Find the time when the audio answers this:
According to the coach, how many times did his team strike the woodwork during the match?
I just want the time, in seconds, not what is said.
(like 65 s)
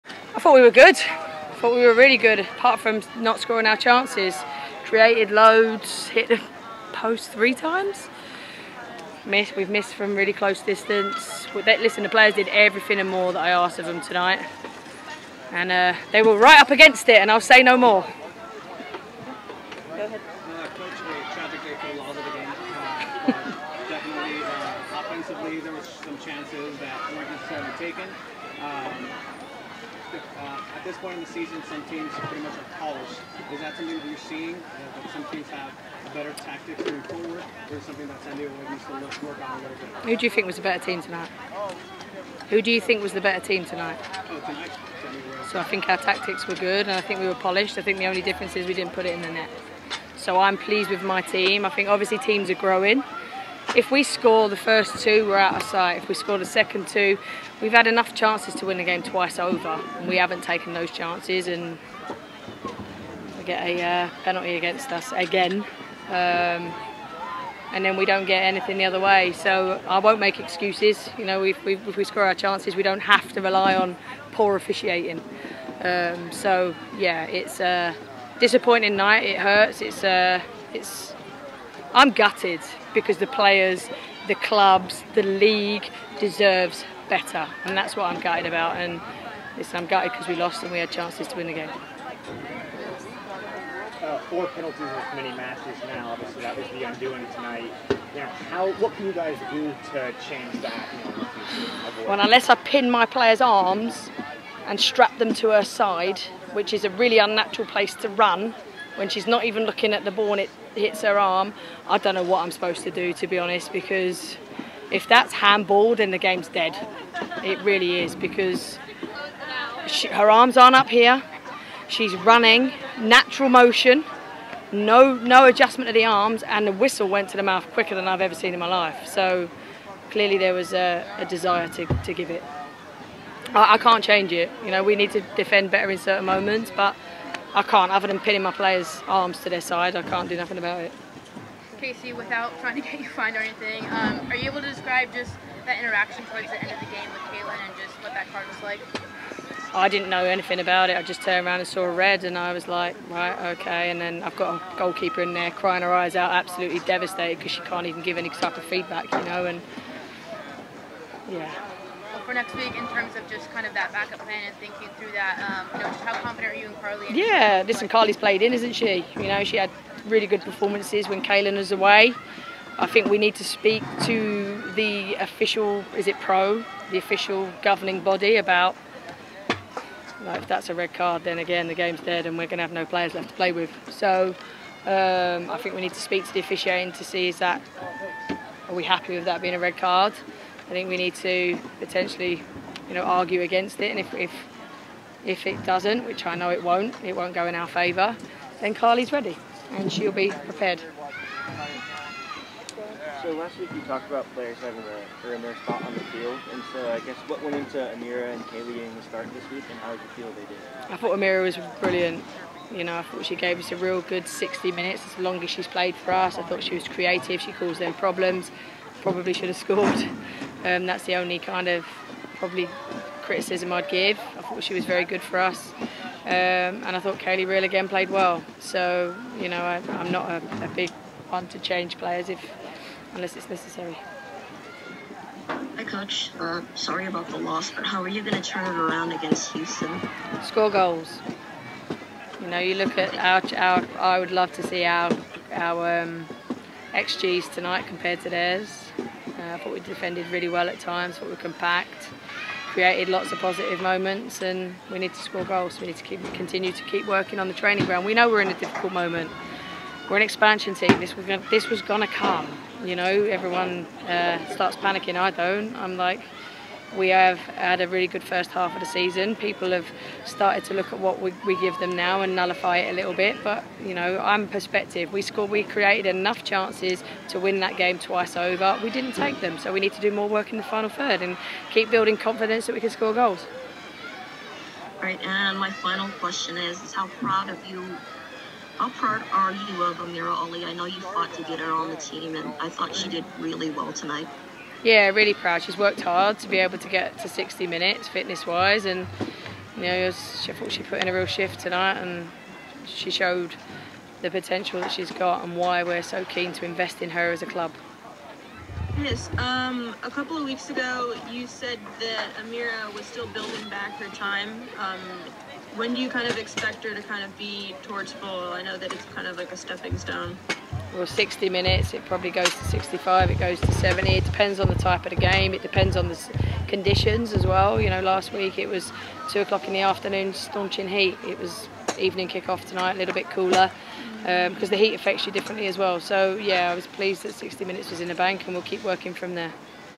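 7 s.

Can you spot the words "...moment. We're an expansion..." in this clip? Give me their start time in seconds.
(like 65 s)
258 s.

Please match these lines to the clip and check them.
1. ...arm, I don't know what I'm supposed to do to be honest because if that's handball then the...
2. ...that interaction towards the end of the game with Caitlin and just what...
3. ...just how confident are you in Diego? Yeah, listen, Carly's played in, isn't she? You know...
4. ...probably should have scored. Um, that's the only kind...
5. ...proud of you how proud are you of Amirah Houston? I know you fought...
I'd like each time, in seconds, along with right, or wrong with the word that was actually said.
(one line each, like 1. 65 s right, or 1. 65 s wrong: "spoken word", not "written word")
1. 111 s right
2. 145 s right
3. 165 s wrong: "Carly", not "Diego"
4. 219 s right
5. 287 s wrong: "Ali", not "Houston".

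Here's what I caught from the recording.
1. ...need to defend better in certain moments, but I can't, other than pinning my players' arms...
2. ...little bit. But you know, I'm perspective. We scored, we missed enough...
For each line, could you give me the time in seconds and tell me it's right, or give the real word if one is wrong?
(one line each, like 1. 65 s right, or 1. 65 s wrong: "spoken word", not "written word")
1. 134 s right
2. 272 s wrong: "created", not "missed".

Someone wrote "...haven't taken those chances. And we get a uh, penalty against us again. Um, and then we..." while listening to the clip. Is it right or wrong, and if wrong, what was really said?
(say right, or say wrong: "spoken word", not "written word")
right.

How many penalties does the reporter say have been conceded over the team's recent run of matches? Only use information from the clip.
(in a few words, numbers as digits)
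4.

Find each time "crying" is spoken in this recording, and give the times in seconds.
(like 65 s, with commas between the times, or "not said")
155 s.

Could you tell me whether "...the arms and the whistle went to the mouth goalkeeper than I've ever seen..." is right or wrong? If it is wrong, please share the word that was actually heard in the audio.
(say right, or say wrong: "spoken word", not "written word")
wrong: "quicker", not "goalkeeper".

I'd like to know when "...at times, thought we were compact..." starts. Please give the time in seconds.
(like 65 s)
250 s.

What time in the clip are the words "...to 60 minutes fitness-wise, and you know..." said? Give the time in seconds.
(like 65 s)
297 s.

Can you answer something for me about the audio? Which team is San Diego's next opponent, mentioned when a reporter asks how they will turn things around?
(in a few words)
Houston.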